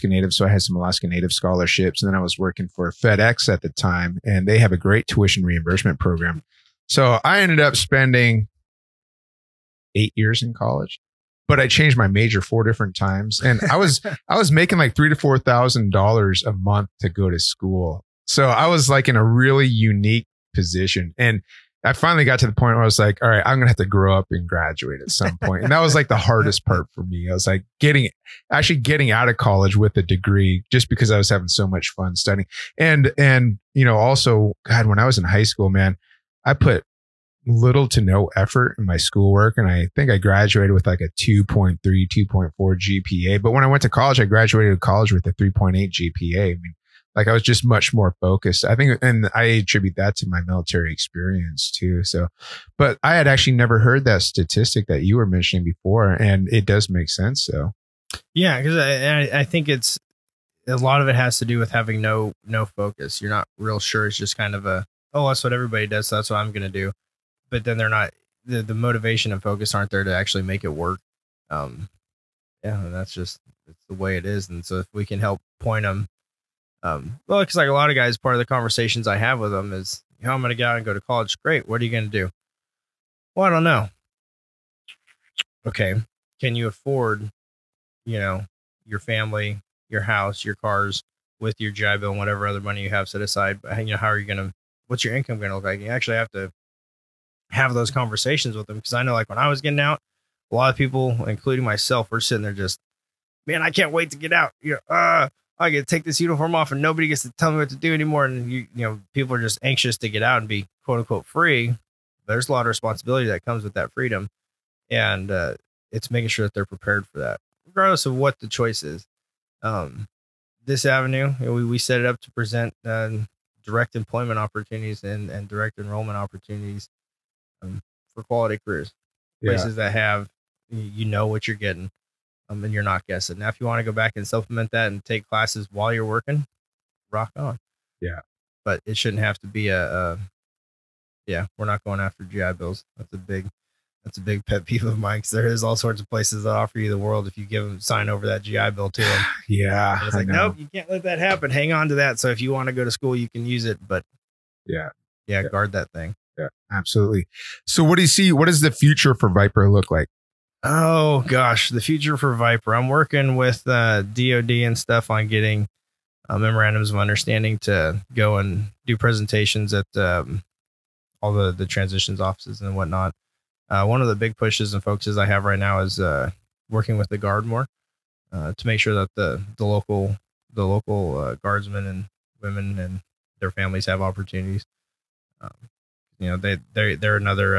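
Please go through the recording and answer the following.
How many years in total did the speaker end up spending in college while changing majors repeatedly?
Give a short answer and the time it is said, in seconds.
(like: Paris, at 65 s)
8, at 9 s.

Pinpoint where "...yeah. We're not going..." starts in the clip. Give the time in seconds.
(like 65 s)
141 s.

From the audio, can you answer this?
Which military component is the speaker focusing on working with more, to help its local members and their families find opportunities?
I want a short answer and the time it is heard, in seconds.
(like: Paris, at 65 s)
the Guard, at 177 s.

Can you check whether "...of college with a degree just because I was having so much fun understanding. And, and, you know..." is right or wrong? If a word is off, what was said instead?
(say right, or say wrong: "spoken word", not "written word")
wrong: "studying", not "understanding".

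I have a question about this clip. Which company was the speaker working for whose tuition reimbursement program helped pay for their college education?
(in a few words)
FedEx.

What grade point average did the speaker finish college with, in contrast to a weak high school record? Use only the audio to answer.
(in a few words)
3.8.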